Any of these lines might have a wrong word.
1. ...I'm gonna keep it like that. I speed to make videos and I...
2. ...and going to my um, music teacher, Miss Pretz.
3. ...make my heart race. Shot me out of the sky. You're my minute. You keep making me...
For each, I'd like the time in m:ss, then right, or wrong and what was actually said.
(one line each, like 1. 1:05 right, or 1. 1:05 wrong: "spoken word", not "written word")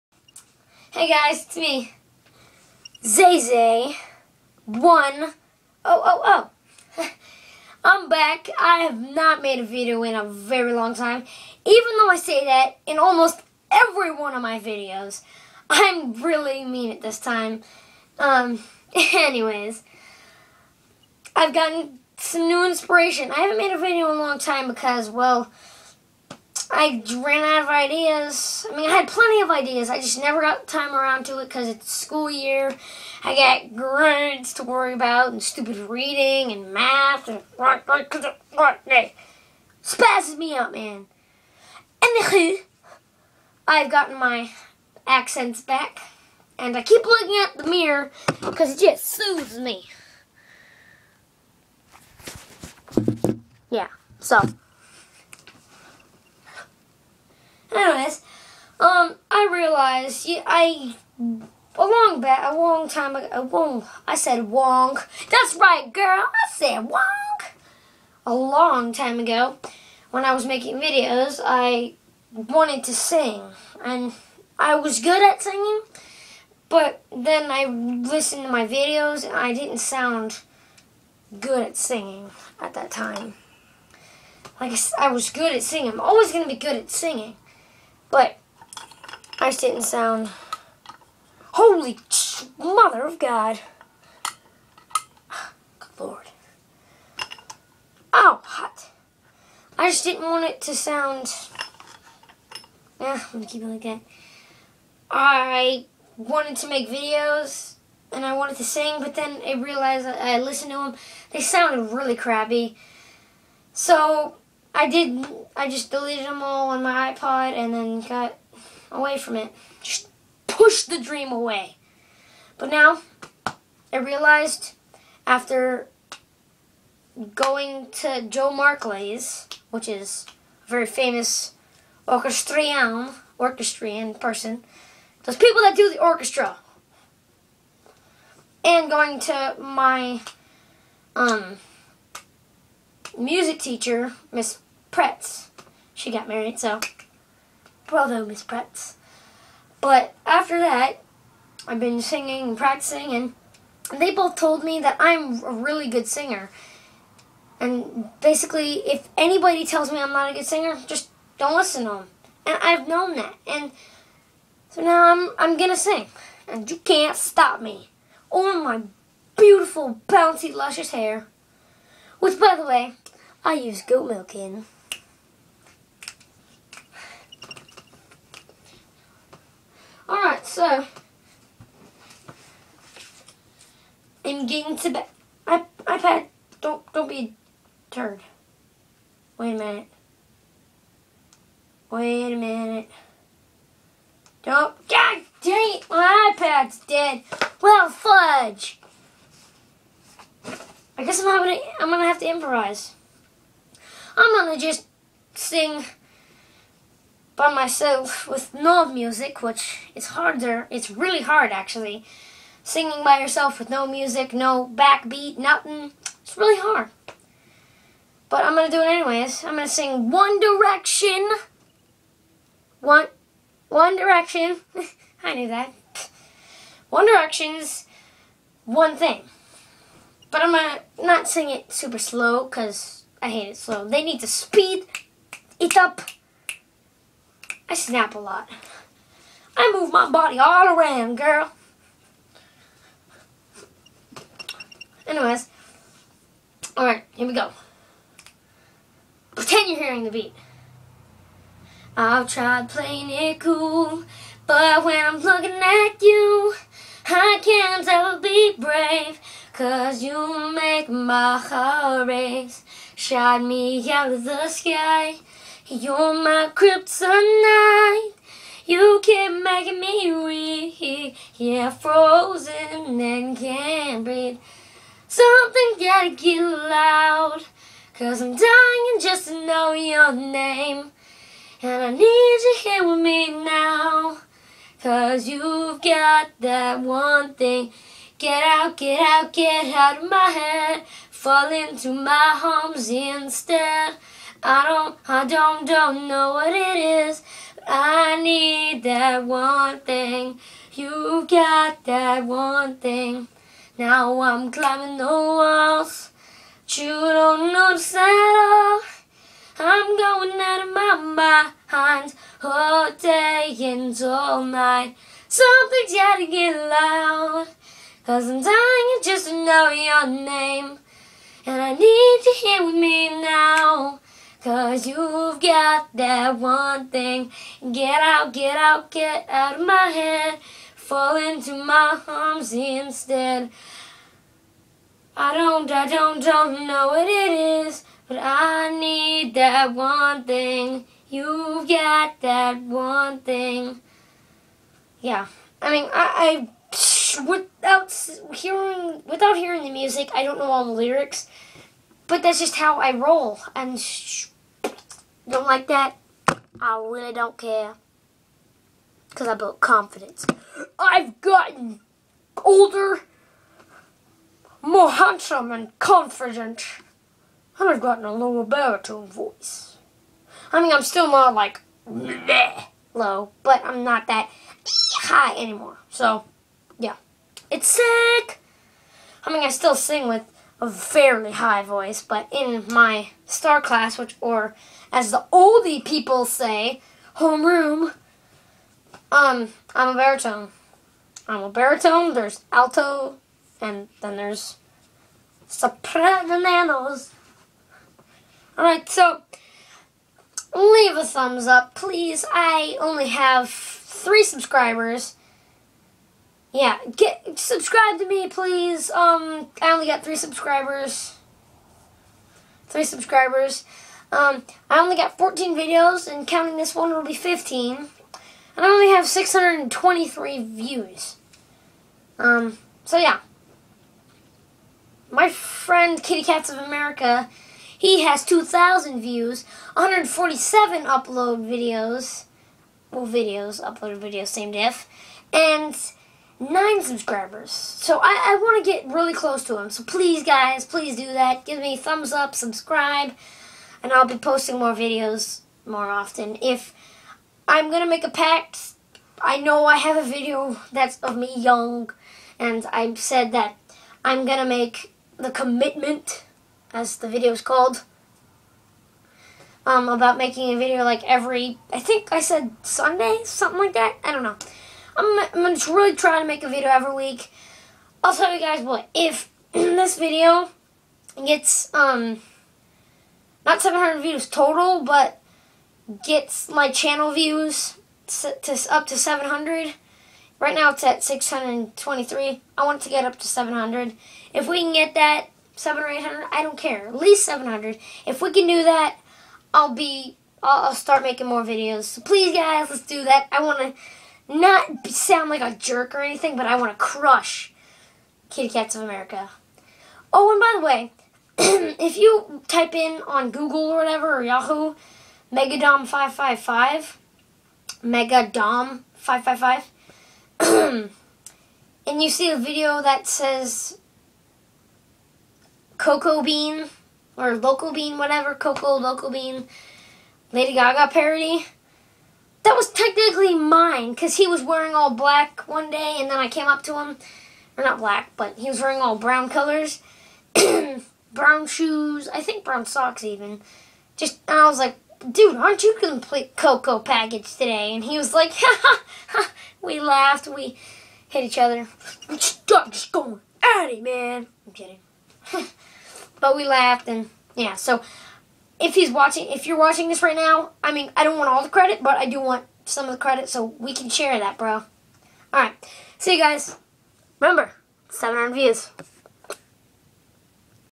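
1. 1:43 wrong: "wanted", not "speed"
2. 2:18 right
3. 4:20 wrong: "kryptonite", not "minute".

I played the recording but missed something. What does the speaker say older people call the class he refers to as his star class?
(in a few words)
Homeroom.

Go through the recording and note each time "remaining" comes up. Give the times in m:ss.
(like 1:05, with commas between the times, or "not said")
not said.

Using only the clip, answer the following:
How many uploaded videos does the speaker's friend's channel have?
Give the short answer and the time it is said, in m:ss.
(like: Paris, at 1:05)
147, at 7:09.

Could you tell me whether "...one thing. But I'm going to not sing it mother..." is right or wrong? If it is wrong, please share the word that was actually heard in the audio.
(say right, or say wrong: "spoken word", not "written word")
wrong: "super", not "mother".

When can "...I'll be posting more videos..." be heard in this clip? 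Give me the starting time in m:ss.
7:23.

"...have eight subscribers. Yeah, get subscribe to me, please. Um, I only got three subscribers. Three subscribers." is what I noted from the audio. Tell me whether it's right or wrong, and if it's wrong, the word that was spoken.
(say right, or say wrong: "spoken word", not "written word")
wrong: "three", not "eight".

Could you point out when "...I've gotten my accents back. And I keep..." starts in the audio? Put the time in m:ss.
0:43.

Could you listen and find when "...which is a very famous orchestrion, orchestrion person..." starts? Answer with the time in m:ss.
2:09.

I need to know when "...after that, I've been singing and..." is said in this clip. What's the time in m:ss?
2:30.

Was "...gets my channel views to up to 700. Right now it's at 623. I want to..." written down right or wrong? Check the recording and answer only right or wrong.
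right.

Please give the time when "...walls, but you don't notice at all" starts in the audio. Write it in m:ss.
5:05.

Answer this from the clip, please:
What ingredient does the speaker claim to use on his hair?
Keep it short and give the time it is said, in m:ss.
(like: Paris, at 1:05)
Goat milk, at 2:53.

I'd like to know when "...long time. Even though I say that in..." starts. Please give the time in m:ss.
0:10.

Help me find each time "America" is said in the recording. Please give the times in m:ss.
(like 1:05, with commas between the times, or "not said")
7:06, 8:18.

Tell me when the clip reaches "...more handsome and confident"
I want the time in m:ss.
6:04.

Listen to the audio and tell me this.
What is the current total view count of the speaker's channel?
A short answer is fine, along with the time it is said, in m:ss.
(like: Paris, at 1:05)
623, at 6:59.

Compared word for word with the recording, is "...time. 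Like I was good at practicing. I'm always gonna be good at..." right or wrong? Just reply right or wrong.
wrong.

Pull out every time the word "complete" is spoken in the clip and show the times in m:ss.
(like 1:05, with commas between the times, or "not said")
8:55.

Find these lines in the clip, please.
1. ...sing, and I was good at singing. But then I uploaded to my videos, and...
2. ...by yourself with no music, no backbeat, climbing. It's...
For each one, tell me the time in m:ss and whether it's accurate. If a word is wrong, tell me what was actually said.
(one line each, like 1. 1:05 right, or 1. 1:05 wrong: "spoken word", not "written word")
1. 1:12 wrong: "listened", not "uploaded"
2. 3:33 wrong: "nothing", not "climbing".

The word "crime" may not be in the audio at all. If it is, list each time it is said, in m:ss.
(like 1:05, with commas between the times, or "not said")
not said.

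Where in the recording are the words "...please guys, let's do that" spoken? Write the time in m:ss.
8:12.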